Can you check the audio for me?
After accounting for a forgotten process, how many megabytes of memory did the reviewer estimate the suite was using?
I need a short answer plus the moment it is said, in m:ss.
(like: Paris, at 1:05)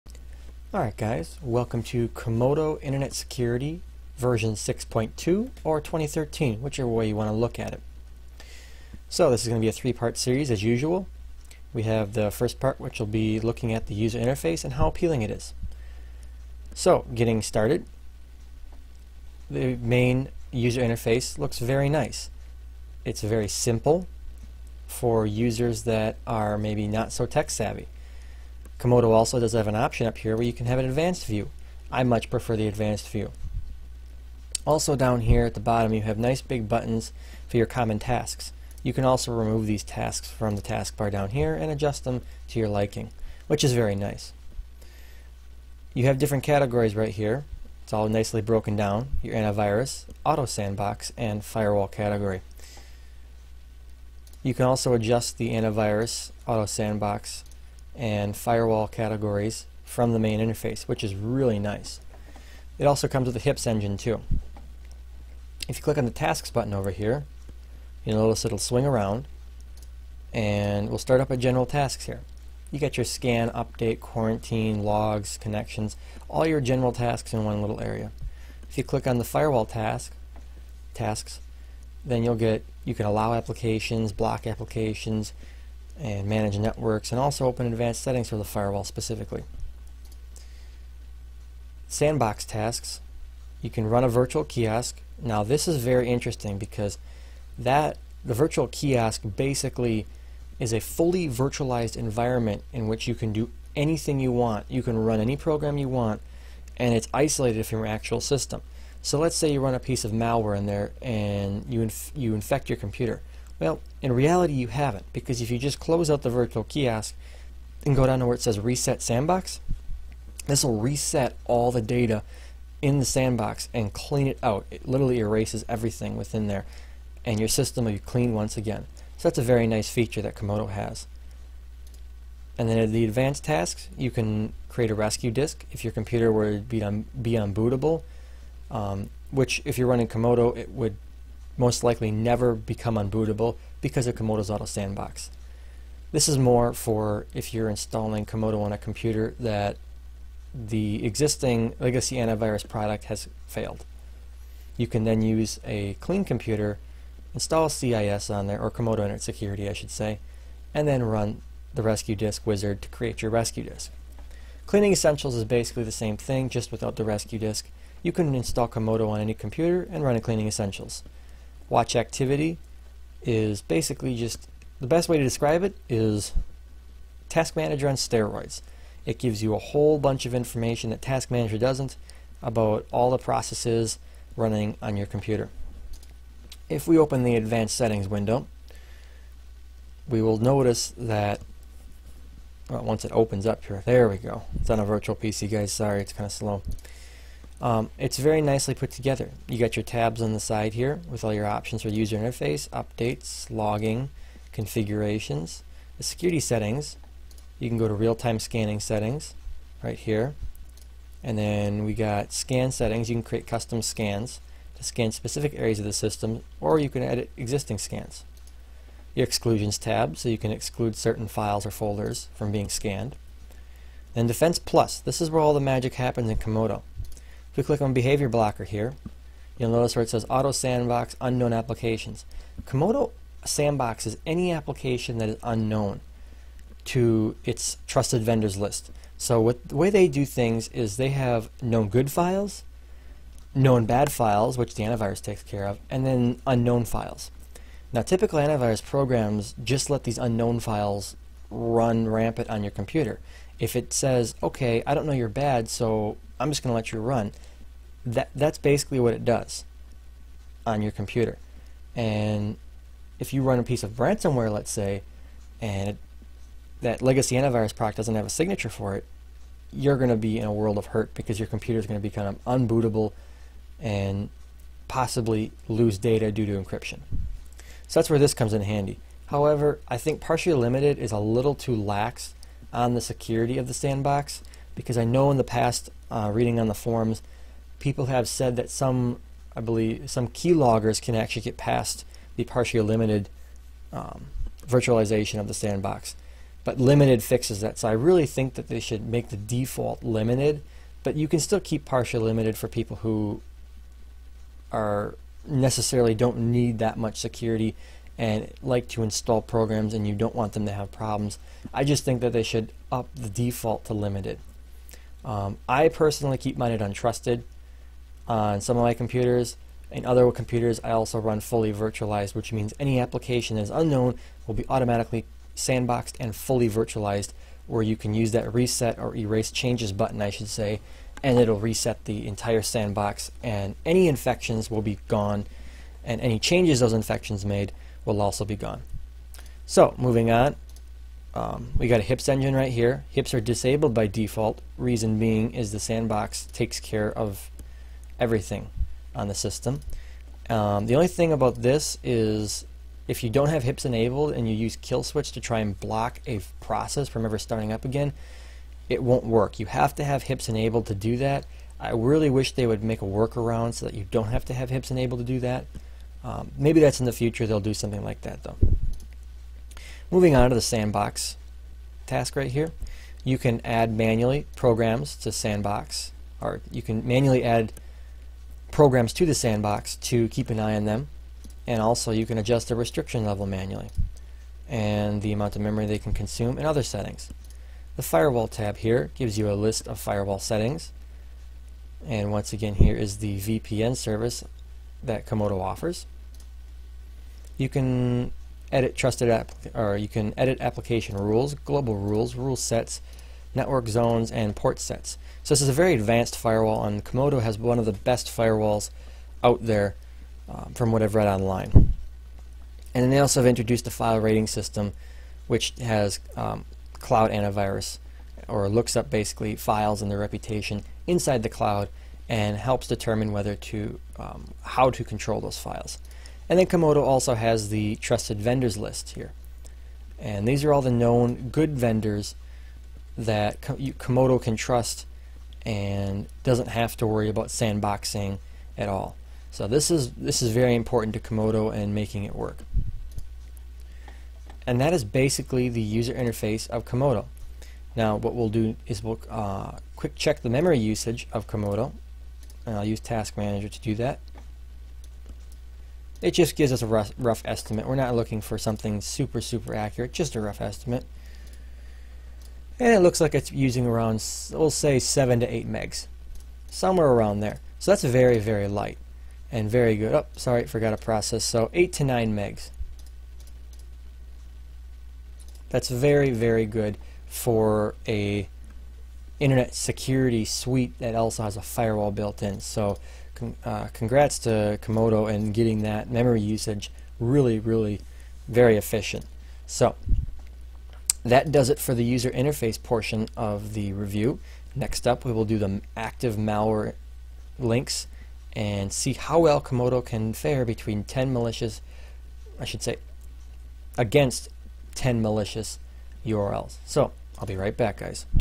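8 to 9 megs, at 7:51.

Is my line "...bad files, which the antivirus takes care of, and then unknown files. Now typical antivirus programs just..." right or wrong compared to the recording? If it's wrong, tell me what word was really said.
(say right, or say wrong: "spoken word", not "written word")
right.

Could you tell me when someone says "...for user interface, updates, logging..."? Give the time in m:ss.
3:21.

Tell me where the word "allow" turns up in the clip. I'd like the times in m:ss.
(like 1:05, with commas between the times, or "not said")
1:23.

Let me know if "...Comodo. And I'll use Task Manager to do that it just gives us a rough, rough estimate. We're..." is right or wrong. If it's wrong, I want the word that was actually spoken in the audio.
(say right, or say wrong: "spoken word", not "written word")
right.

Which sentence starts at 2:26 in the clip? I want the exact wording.
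This is more for if you're installing Comodo on a computer that the existing legacy antivirus product has failed.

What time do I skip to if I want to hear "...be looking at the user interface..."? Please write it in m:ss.
0:13.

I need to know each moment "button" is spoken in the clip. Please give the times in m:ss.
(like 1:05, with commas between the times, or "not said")
0:36, 1:06, 5:29.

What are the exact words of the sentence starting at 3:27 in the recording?
You can go to real-time scanning settings right here.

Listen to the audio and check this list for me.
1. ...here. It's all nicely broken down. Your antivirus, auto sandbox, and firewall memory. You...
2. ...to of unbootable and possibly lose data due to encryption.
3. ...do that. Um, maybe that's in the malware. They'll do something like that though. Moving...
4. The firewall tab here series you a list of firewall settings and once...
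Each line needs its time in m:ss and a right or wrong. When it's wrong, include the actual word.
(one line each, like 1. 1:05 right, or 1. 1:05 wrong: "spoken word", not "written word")
1. 0:47 wrong: "category", not "memory"
2. 4:32 right
3. 6:05 wrong: "future", not "malware"
4. 6:27 wrong: "gives", not "series".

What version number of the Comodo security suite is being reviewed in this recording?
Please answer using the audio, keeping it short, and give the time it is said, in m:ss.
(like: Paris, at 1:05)
6.2, at 0:04.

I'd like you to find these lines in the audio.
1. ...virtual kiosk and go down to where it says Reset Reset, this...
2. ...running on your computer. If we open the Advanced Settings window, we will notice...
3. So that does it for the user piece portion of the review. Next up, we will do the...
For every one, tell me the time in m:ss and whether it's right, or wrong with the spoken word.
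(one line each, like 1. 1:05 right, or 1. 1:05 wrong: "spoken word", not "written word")
1. 1:56 wrong: "Sandbox", not "Reset"
2. 3:04 right
3. 8:09 wrong: "interface", not "piece".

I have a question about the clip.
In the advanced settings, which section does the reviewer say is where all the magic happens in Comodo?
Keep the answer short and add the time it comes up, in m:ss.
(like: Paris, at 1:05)
Defense Plus, at 3:44.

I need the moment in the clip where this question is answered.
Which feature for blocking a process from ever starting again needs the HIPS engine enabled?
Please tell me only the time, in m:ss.
5:54.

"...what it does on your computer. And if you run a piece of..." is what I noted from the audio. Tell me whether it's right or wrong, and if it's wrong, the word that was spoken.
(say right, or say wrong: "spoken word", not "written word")
right.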